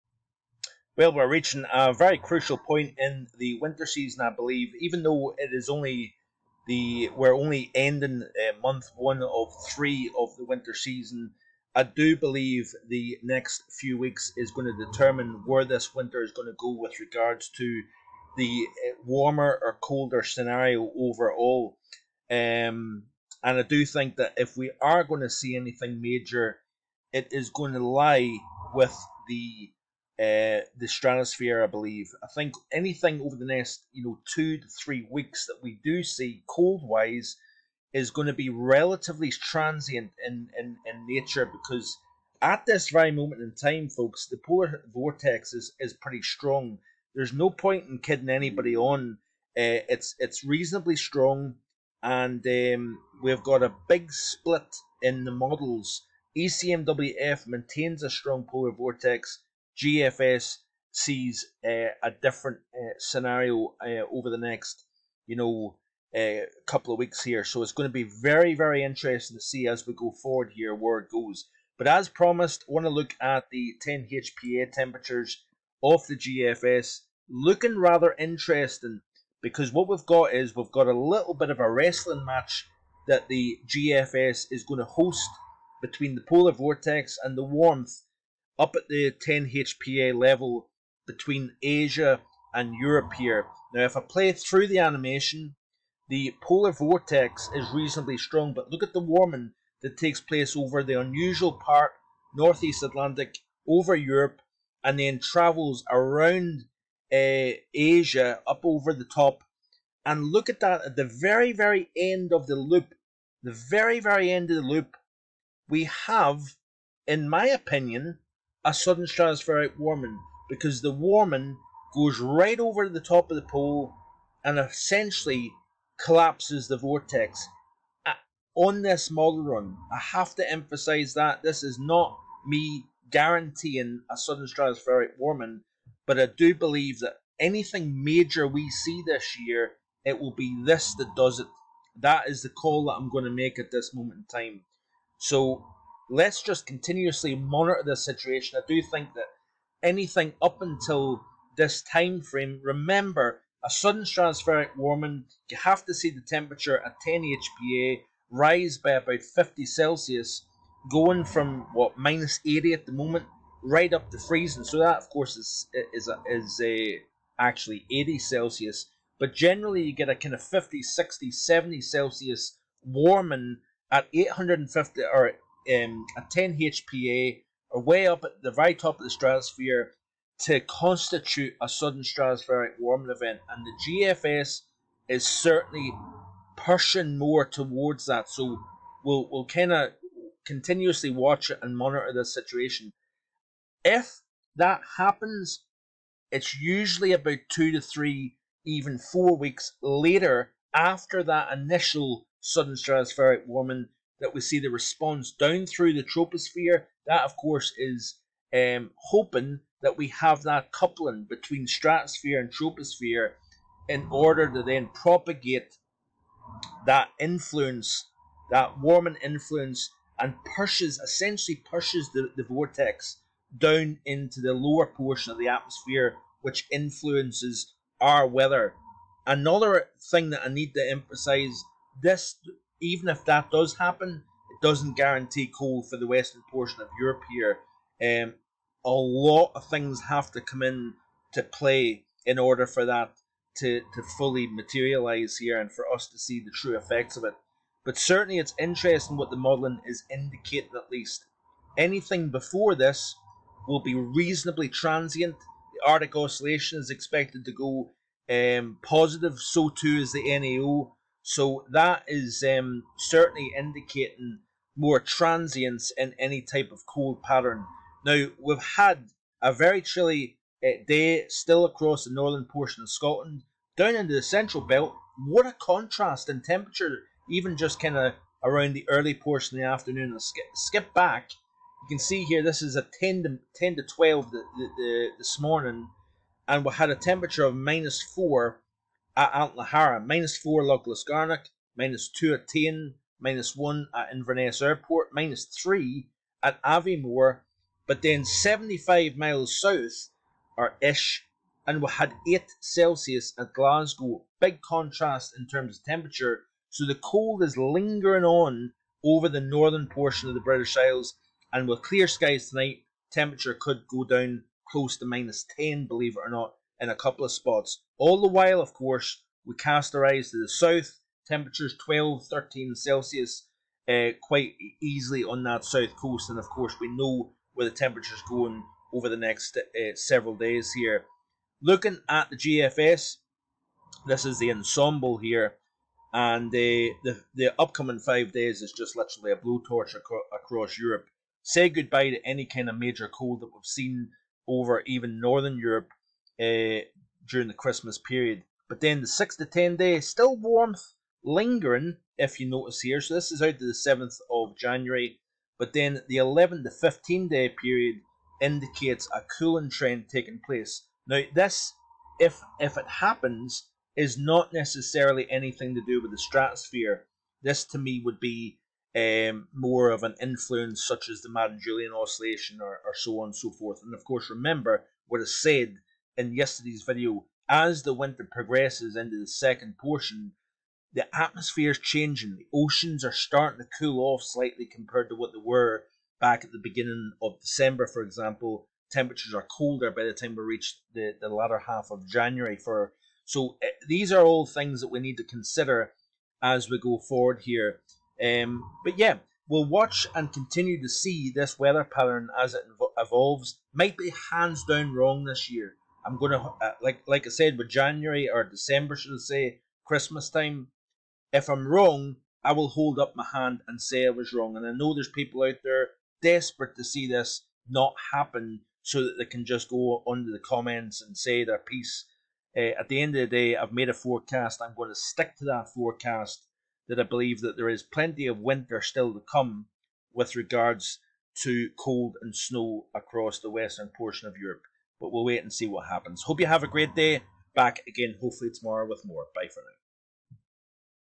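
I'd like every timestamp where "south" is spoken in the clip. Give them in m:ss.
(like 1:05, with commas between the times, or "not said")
4:59, 5:20, 5:25.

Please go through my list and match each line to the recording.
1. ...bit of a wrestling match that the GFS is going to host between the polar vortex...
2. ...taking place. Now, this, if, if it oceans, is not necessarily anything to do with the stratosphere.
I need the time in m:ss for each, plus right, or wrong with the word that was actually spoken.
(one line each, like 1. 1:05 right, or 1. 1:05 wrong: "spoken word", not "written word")
1. 1:21 right
2. 6:00 wrong: "happens", not "oceans".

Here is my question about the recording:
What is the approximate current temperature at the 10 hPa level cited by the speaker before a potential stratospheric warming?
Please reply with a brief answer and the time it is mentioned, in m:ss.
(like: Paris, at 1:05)
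-80, at 2:41.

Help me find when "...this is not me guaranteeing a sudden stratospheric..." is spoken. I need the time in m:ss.
2:11.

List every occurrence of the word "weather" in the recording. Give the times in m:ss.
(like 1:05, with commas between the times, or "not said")
3:48, 6:41.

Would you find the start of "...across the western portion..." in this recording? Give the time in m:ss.
7:12.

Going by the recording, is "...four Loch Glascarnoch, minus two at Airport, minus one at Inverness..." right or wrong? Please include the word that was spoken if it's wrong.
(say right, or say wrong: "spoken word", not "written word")
wrong: "Tain", not "Airport".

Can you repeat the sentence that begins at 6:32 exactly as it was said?
For so uh, these are all things that we need to consider as we go forward here.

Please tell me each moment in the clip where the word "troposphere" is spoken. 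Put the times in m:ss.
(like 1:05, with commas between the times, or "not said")
3:26, 3:32.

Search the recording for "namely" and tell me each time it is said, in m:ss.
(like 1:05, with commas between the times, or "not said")
not said.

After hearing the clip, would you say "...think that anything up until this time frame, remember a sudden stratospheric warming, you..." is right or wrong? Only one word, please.
right.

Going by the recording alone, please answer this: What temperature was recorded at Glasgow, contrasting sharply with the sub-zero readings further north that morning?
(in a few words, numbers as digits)
8 Celsius.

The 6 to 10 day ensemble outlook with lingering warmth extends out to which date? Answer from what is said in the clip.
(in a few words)
7th of January.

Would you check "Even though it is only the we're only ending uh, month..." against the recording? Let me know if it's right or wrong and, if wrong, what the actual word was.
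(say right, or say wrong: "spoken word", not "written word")
right.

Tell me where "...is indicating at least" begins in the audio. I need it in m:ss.
4:09.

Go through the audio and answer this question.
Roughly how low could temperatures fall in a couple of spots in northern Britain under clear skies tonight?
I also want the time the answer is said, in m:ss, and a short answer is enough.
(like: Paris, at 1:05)
-10, at 5:15.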